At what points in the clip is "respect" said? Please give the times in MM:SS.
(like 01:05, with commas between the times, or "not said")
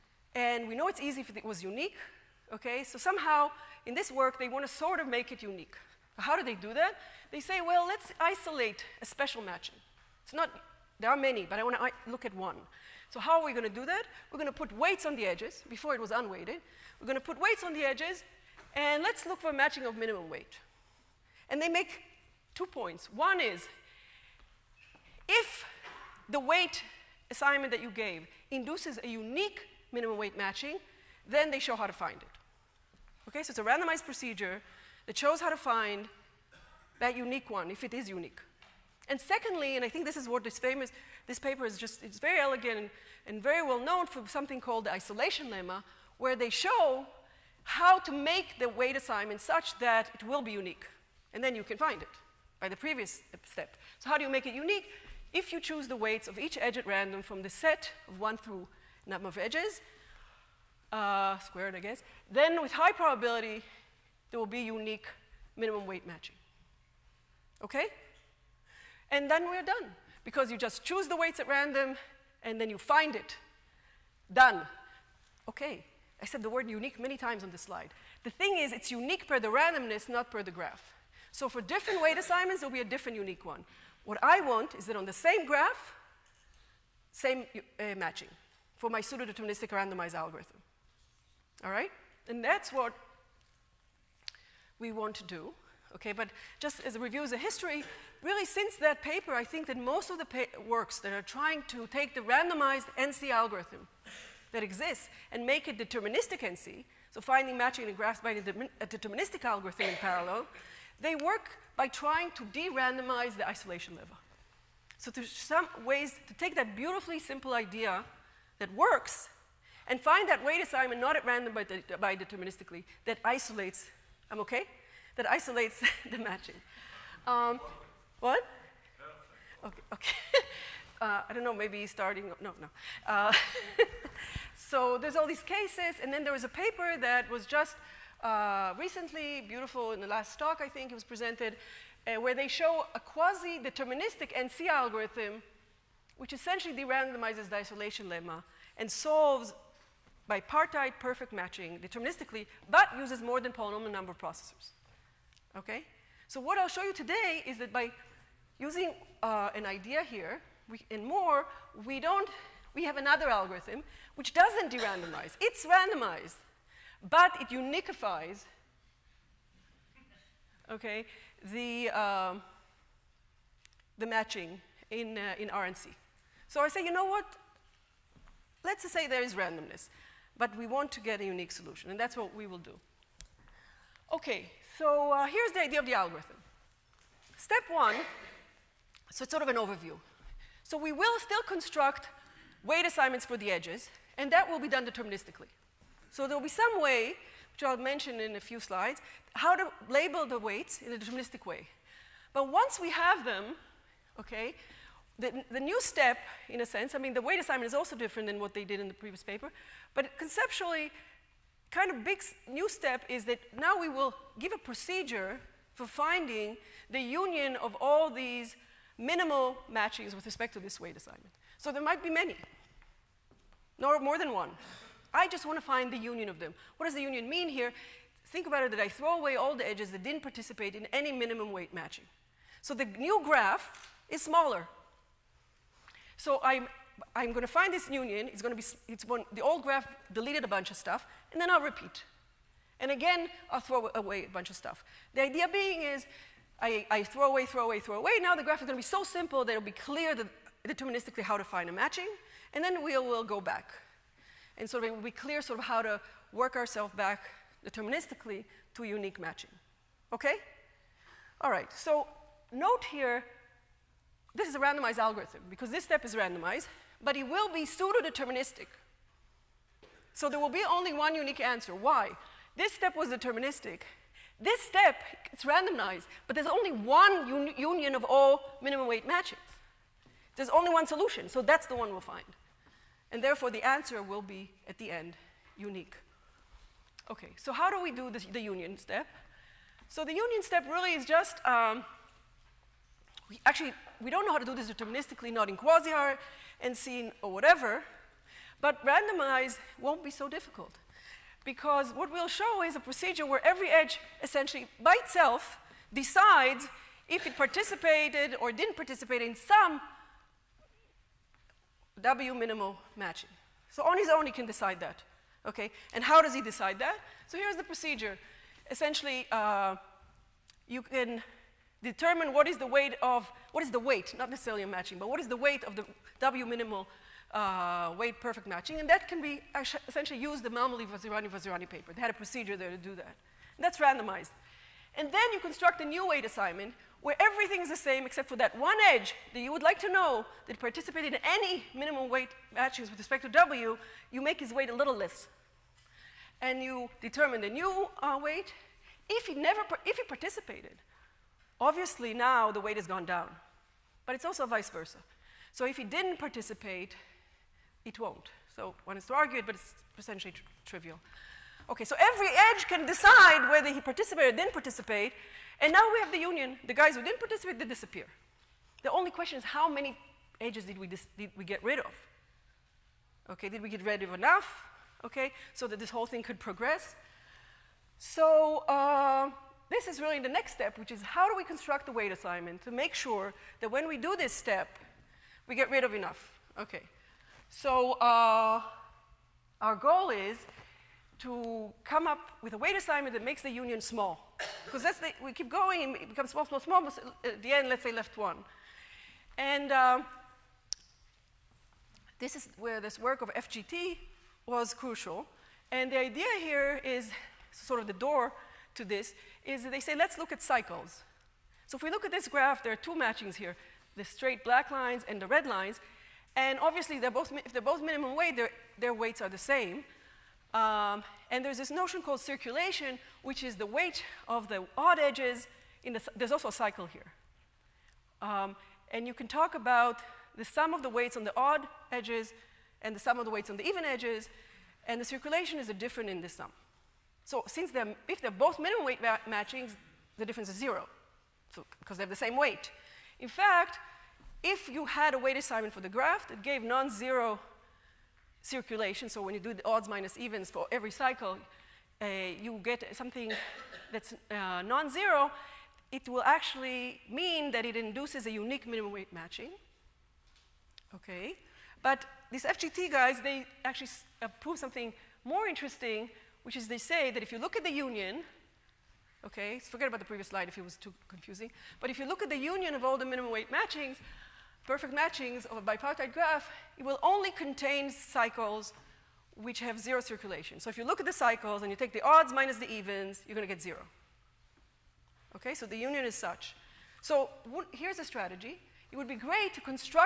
03:40, 05:42.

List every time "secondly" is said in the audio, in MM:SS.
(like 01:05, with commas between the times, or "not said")
00:39.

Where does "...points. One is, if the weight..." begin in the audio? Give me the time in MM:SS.
00:22.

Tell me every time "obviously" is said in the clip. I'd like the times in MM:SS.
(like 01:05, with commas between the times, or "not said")
05:51, 06:56.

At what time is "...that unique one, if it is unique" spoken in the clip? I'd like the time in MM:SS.
00:36.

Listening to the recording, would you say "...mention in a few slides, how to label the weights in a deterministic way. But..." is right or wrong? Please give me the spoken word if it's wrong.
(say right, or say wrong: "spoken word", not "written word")
right.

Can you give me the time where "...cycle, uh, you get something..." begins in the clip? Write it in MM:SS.
07:30.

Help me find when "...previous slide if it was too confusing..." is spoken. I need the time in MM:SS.
07:50.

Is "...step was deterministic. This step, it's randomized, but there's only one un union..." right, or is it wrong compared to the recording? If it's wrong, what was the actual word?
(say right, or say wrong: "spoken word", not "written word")
right.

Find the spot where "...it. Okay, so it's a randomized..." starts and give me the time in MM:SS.
00:32.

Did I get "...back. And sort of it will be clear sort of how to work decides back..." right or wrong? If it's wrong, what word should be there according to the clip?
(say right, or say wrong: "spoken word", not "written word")
wrong: "ourselves", not "decides".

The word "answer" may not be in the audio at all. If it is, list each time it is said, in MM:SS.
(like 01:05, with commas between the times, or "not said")
04:31, 04:43.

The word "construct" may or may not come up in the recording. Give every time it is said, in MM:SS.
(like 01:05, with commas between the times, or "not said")
03:11, 05:35, 06:21.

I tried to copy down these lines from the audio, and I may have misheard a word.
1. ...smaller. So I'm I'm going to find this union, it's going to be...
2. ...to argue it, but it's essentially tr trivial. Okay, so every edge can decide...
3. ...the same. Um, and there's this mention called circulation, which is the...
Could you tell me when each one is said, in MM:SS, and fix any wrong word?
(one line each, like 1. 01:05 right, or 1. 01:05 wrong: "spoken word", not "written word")
1. 03:54 right
2. 05:59 right
3. 06:59 wrong: "notion", not "mention".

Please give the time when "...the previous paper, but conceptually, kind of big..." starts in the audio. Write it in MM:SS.
03:28.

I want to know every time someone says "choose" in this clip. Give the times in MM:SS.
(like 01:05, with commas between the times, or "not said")
00:55, 01:10.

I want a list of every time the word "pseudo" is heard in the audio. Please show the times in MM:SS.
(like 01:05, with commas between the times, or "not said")
01:29, 04:27.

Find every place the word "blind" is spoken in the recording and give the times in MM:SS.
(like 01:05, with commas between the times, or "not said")
not said.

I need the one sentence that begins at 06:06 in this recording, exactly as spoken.
The guys who didn't participate, they disappear.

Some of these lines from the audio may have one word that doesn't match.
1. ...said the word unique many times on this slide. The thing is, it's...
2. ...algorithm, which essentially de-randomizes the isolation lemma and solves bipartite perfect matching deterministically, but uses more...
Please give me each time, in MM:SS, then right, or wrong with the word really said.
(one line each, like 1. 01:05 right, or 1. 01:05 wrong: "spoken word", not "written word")
1. 01:16 right
2. 02:24 right.